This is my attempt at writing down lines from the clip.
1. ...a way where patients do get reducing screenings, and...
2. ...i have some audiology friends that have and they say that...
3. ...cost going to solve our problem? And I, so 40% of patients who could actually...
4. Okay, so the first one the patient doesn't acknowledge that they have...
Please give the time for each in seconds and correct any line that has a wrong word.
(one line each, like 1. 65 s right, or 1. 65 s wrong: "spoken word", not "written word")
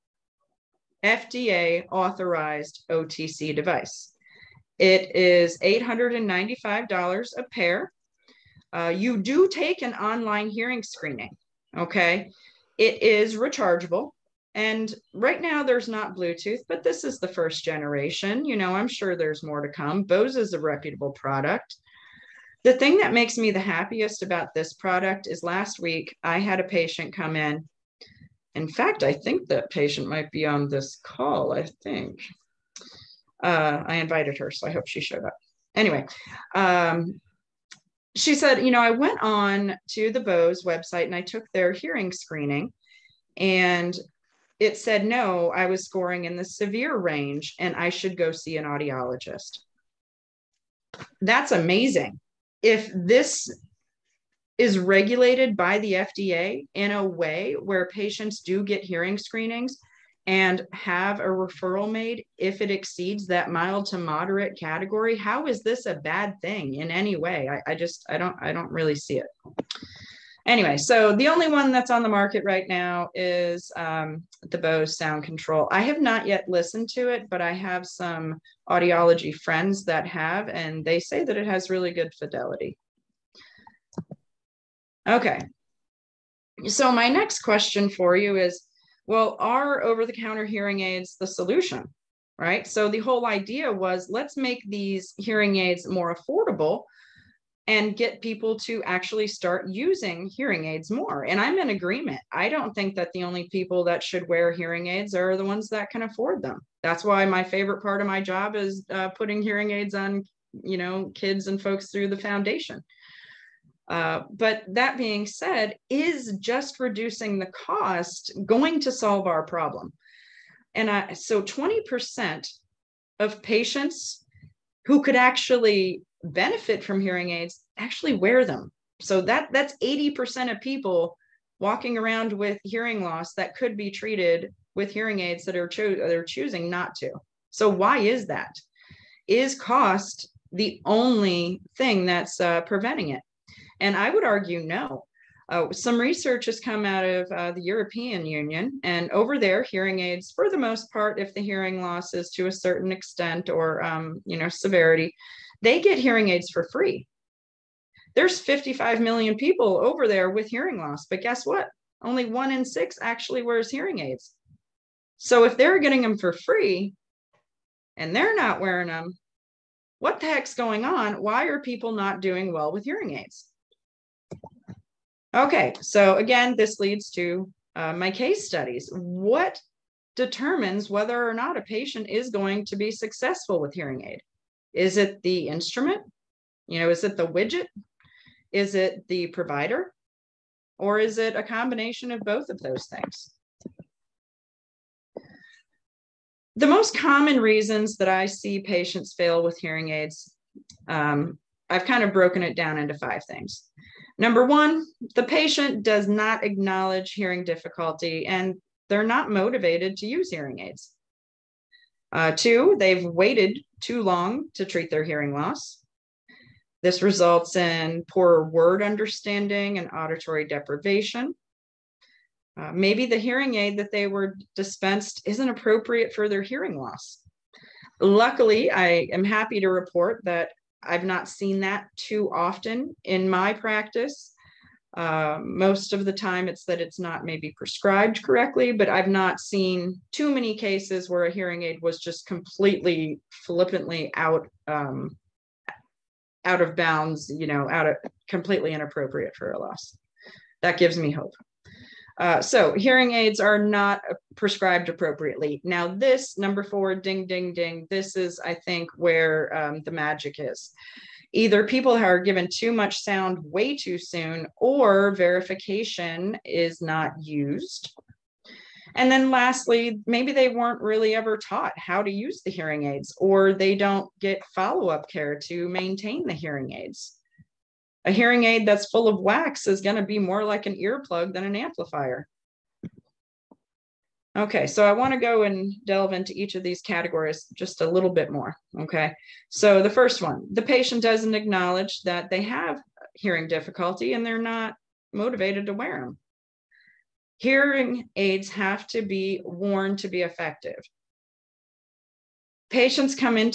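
1. 56 s wrong: "hearing", not "reducing"
2. 77 s right
3. 117 s wrong: "20", not "40"
4. 288 s right.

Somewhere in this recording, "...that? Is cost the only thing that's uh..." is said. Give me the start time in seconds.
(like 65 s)
138 s.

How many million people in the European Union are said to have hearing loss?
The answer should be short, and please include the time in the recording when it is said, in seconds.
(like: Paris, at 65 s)
55 million, at 158 s.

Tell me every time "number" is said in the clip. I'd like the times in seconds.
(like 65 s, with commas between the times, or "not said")
204 s, 256 s.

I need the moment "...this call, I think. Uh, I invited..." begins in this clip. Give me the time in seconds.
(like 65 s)
30 s.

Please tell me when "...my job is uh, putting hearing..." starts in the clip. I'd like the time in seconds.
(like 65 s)
108 s.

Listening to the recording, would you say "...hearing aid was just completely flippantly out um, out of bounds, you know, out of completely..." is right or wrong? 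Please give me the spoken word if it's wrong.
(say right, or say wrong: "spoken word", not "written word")
right.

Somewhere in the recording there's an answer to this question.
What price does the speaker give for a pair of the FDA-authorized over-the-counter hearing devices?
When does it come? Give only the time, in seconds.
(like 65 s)
5 s.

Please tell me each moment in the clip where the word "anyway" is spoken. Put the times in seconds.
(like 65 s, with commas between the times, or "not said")
35 s, 70 s.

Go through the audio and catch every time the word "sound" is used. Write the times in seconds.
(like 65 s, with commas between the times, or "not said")
74 s, 263 s.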